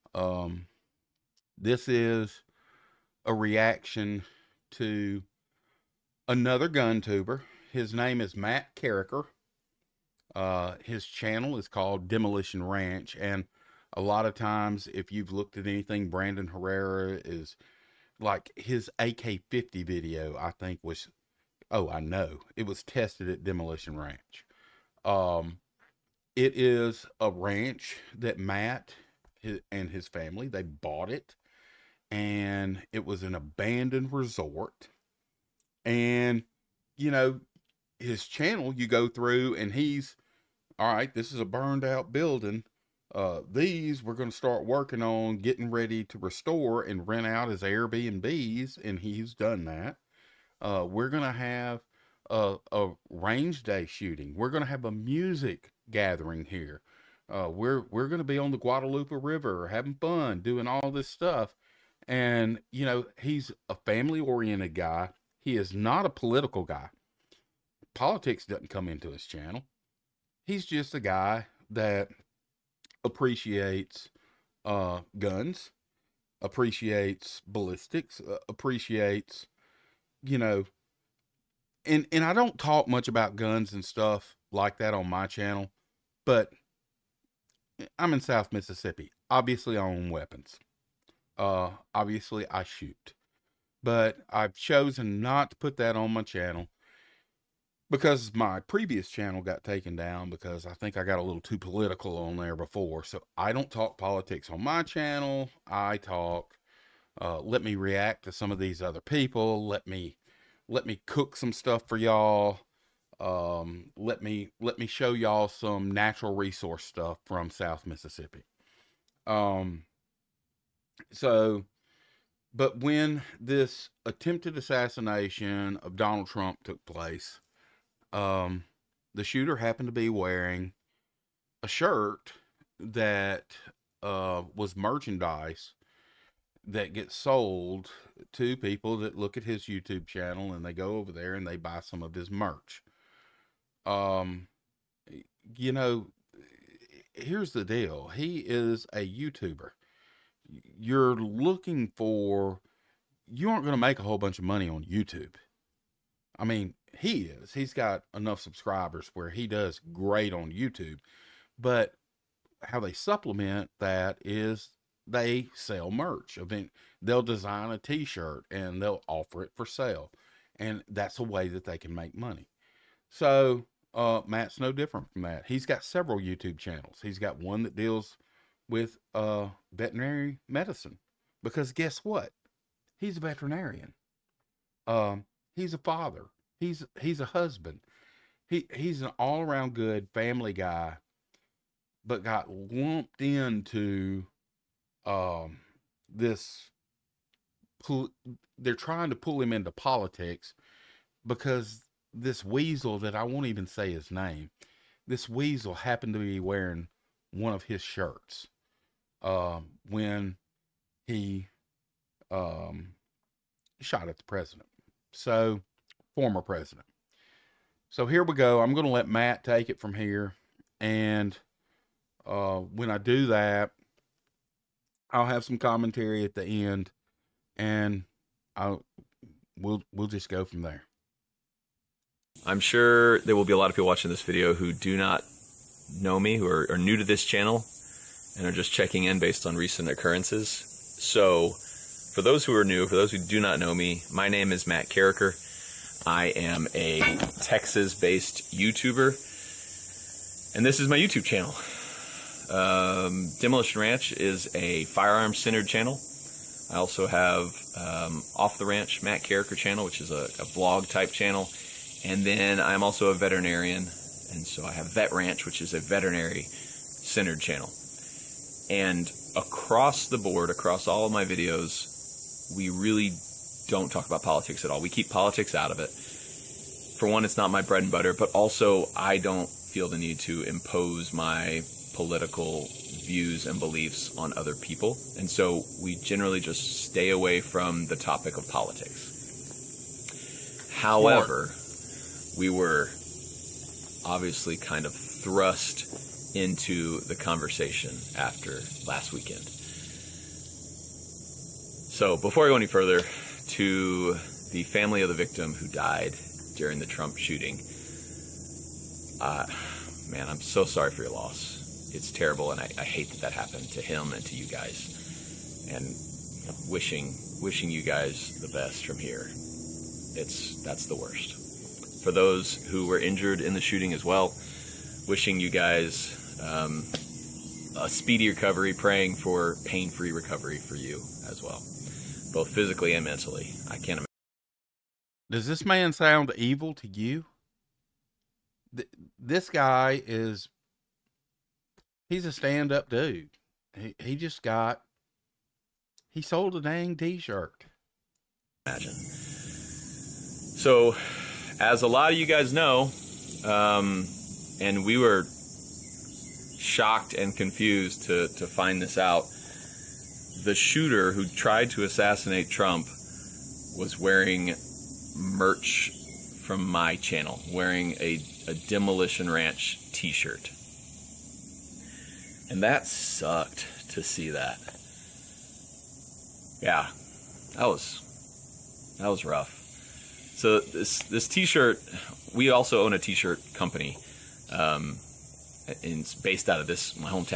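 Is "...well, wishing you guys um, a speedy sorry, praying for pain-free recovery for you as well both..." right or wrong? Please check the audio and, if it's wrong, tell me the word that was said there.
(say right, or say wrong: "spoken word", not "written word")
wrong: "recovery", not "sorry".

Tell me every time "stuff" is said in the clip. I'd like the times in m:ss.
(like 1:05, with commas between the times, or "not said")
1:01, 1:23, 1:51, 1:56.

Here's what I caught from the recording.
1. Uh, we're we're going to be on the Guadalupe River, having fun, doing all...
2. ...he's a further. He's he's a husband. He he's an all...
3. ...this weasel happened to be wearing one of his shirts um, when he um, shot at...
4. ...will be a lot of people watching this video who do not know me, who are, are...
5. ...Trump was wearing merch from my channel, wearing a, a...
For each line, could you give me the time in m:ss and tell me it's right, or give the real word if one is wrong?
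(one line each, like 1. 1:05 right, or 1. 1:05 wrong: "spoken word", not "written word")
1. 0:57 right
2. 3:05 wrong: "father", not "further"
3. 3:25 right
4. 3:53 right
5. 6:02 right.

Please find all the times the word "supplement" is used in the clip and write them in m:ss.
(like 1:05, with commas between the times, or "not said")
2:42.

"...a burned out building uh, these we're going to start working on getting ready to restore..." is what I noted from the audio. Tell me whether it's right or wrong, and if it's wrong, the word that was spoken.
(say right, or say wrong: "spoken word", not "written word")
right.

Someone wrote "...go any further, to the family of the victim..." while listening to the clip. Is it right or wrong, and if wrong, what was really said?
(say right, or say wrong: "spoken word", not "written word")
right.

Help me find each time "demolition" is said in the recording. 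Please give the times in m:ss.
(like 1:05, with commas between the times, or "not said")
0:12, 0:23, 4:13, 6:08.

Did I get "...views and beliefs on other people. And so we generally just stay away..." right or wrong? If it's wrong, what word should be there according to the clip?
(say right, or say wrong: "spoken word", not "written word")
right.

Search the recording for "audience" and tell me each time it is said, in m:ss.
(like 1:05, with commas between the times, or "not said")
not said.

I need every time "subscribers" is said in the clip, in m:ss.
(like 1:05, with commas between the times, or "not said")
2:38.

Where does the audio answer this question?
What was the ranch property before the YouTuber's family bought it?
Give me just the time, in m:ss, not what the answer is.
0:33.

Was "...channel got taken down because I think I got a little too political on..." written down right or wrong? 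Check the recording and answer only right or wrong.
right.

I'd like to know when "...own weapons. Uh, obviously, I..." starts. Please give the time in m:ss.
1:29.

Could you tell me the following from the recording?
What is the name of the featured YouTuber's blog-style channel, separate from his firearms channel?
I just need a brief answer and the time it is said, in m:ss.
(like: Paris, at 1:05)
Off the Ranch, at 4:18.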